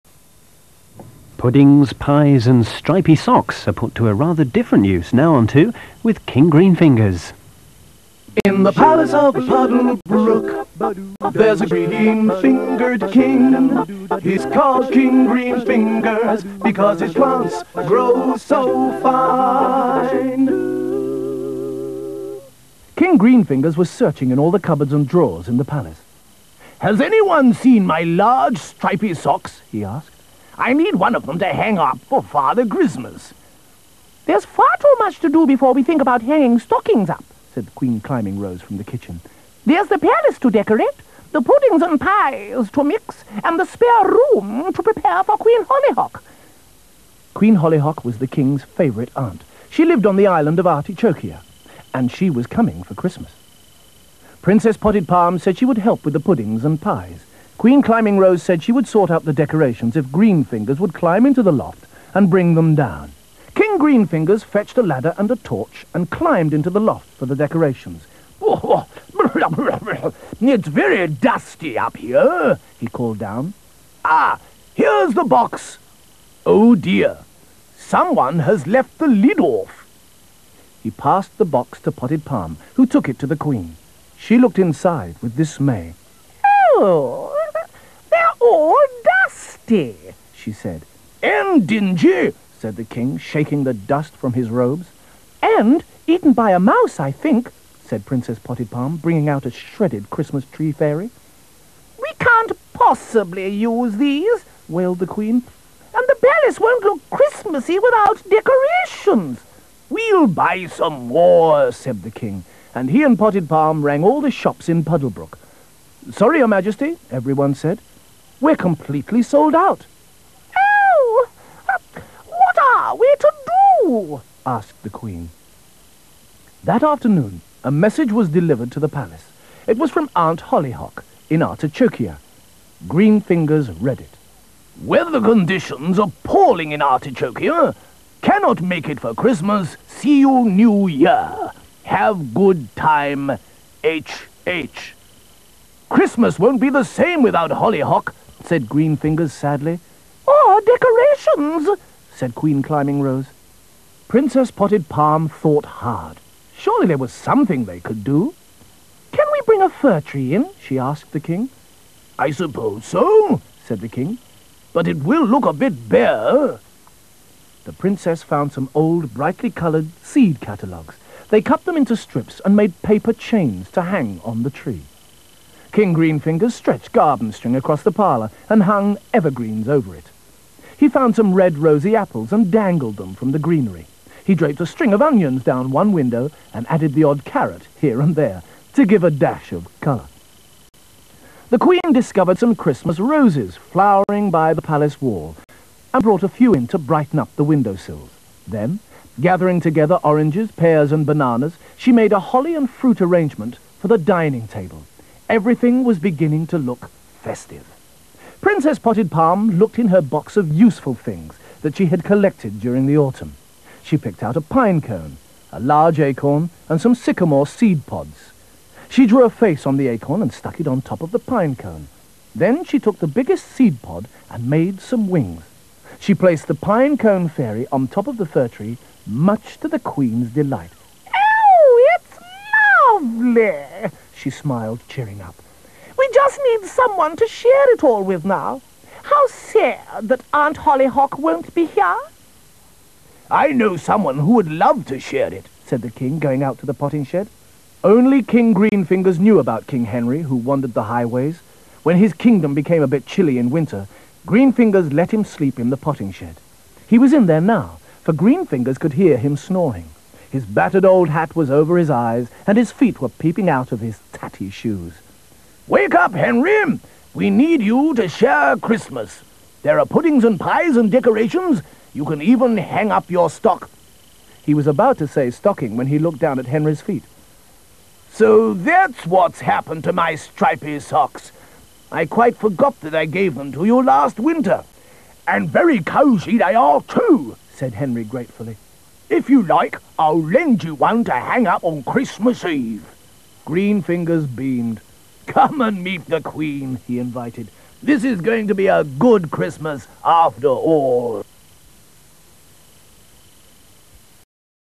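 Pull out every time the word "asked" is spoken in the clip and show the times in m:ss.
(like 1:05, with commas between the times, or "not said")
0:29, 2:04, 2:40.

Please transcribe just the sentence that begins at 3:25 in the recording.
Everything was beginning to look festive.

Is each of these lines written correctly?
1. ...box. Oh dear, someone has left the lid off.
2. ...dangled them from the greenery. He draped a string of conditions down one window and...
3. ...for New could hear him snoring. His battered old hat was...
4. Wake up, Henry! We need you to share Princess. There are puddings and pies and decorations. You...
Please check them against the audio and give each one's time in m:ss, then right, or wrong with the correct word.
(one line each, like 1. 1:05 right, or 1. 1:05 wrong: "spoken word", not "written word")
1. 1:15 right
2. 3:02 wrong: "onions", not "conditions"
3. 4:18 wrong: "Greenfingers", not "New"
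4. 4:25 wrong: "Christmas", not "Princess".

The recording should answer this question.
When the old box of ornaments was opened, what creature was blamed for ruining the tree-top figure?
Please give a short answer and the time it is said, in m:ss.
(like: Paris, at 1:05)
A mouse, at 1:36.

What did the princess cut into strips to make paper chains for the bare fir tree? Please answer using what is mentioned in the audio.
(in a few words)
Seed catalogues.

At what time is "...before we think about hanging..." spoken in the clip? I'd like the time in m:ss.
0:35.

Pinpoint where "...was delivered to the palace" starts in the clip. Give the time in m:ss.
2:08.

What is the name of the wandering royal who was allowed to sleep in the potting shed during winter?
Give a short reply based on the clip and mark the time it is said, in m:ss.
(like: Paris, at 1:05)
King Henry, at 4:09.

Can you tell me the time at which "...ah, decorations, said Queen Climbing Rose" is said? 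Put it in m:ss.
2:30.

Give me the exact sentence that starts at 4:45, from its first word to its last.
And very cozy they are, too, said Henry gratefully.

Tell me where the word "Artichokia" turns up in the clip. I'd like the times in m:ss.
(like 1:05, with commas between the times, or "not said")
0:50, 2:11, 2:16.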